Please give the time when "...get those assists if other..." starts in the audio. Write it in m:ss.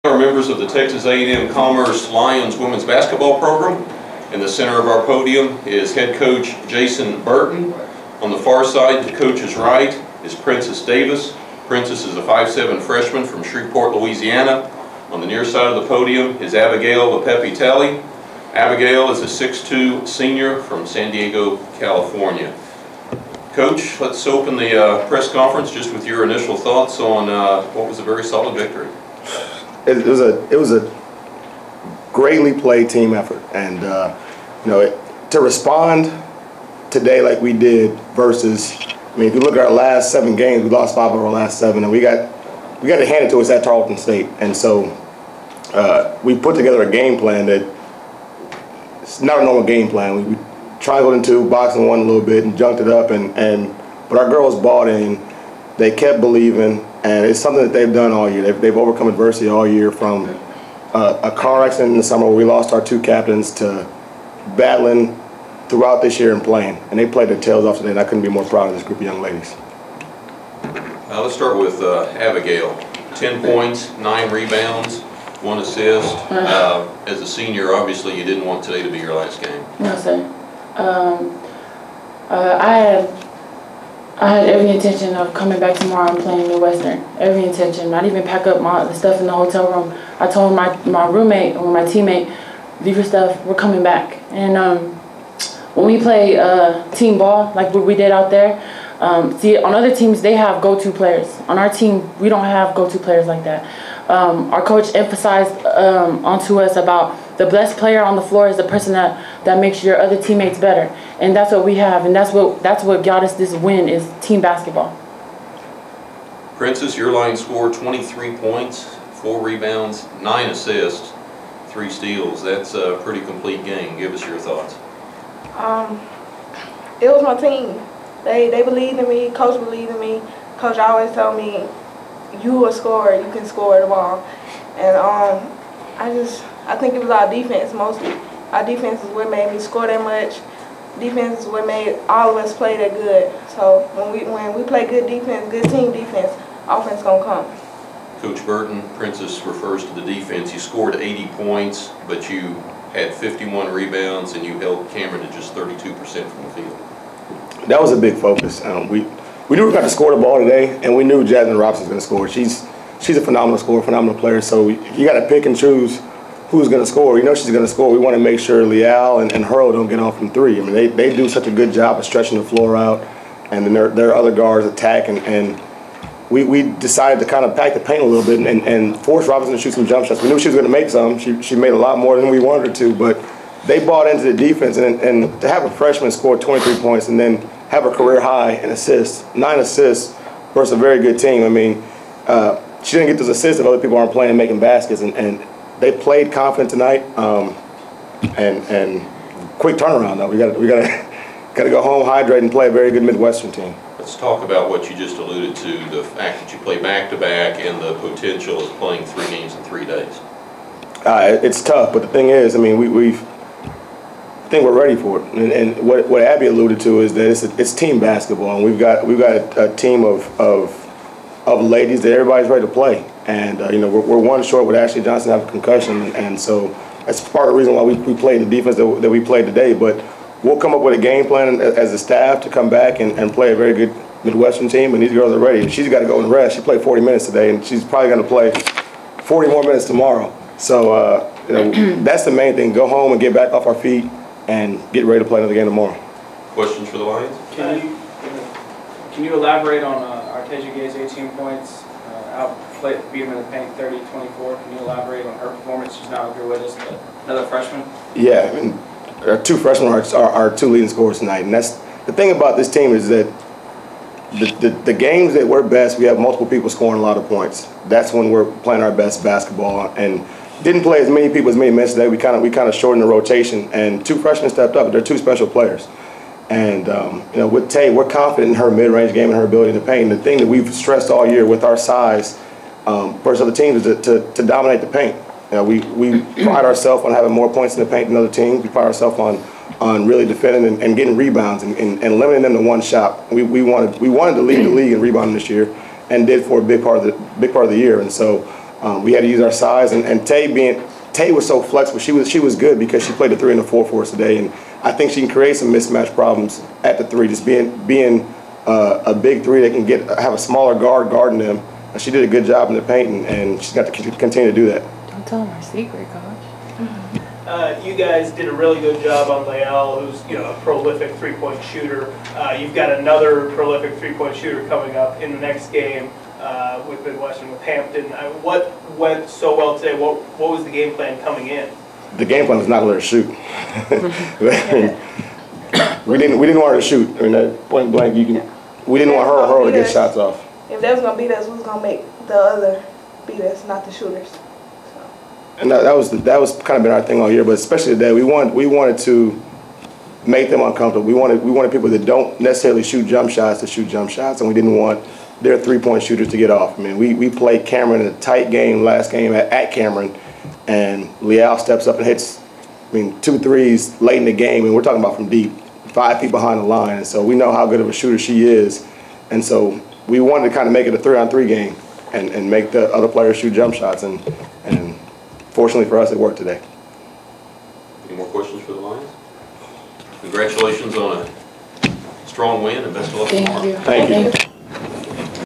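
3:13.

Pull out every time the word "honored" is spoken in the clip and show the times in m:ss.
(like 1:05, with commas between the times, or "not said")
not said.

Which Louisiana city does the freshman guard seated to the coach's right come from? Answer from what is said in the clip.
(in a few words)
Shreveport.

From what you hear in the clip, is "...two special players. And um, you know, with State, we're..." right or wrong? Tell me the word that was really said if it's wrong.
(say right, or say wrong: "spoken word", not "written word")
wrong: "Tay", not "State".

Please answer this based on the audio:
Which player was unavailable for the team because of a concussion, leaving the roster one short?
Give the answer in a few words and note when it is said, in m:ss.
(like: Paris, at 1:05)
Ashley Johnson, at 3:44.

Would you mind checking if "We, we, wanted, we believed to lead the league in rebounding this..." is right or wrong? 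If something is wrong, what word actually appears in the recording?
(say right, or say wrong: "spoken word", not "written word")
wrong: "wanted", not "believed".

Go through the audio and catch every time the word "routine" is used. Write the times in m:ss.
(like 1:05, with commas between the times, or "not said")
not said.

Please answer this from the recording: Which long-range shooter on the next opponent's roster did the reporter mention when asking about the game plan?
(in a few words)
Hampton.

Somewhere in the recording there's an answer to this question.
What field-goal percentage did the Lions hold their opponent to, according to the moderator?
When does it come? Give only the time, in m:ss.
2:35.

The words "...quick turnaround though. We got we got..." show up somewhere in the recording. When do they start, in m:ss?
3:19.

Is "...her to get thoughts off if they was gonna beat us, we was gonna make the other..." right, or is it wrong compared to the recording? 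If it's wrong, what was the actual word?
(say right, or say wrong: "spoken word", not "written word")
wrong: "shots", not "thoughts".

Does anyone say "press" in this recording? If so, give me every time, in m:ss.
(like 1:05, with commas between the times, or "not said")
0:25.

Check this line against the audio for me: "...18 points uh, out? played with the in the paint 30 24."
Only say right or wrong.
right.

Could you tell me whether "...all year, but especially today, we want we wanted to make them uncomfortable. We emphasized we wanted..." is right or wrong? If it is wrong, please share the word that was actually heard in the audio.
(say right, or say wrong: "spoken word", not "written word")
wrong: "wanted", not "emphasized".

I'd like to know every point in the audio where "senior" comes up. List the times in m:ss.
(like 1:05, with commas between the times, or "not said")
0:20, 1:17.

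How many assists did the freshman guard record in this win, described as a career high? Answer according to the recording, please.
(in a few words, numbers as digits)
9.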